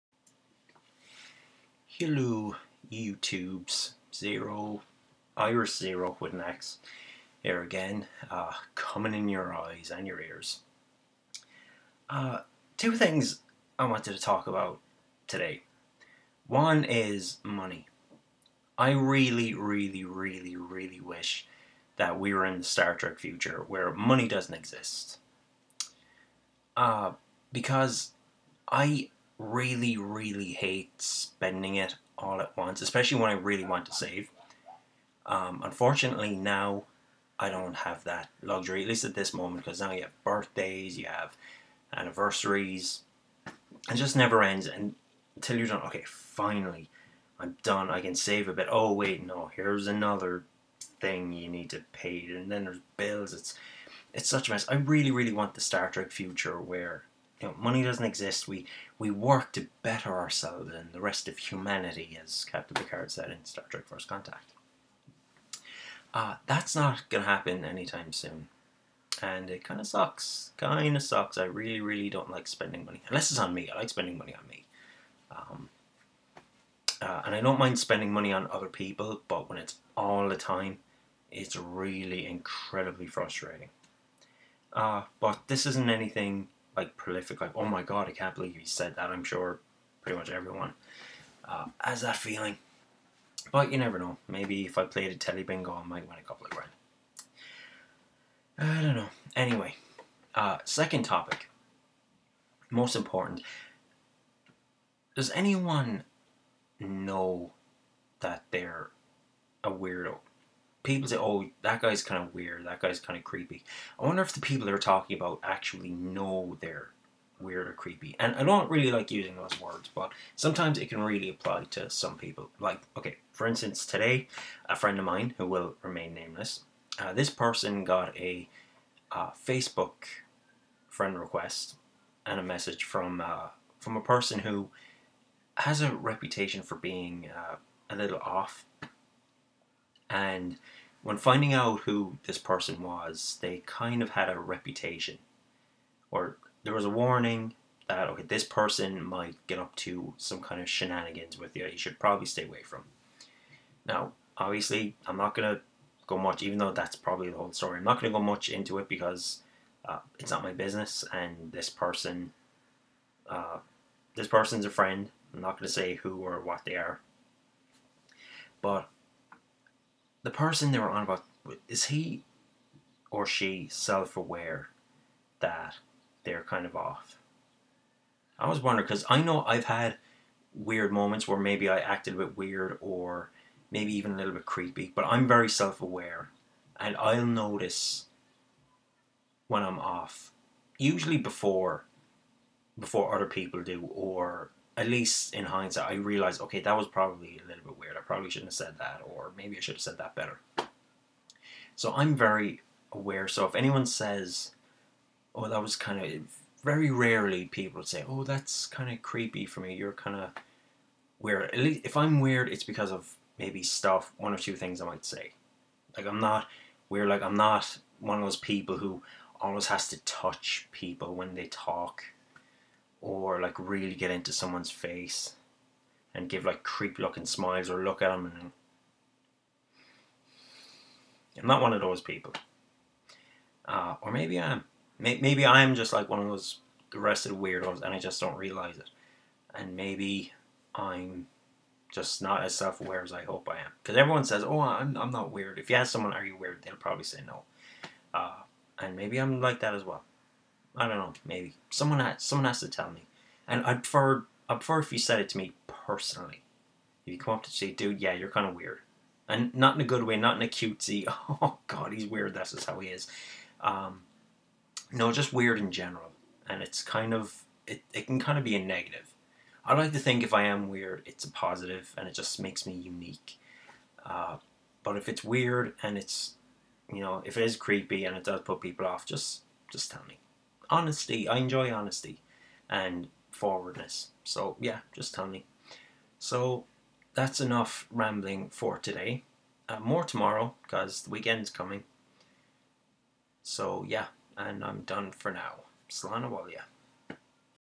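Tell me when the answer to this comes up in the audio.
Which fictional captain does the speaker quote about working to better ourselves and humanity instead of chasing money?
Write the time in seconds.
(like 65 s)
62 s.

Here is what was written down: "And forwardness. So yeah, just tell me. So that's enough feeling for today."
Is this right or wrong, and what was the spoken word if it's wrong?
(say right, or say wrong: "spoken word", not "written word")
wrong: "rambling", not "feeling".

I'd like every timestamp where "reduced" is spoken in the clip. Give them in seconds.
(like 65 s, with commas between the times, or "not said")
not said.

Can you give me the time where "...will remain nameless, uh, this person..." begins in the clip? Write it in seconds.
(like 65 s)
125 s.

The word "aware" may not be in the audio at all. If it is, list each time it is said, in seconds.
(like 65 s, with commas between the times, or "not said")
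173 s, 185 s, 202 s, 242 s.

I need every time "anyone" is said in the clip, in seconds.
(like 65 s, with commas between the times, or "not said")
105 s, 203 s.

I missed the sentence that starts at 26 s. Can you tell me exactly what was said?
Uh, because I really, really hate spending it all at once, especially when I really want to save.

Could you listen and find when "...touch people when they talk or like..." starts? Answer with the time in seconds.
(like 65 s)
220 s.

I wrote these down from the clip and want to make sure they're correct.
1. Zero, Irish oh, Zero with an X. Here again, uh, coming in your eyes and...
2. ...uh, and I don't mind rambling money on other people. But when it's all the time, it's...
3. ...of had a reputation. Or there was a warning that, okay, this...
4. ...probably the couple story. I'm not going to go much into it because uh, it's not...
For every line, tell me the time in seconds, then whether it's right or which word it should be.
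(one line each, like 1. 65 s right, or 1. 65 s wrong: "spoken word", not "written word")
1. 4 s right
2. 77 s wrong: "spending", not "rambling"
3. 144 s right
4. 156 s wrong: "whole", not "couple".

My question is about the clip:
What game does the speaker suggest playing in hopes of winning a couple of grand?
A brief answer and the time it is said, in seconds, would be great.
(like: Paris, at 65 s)
telly bingo, at 95 s.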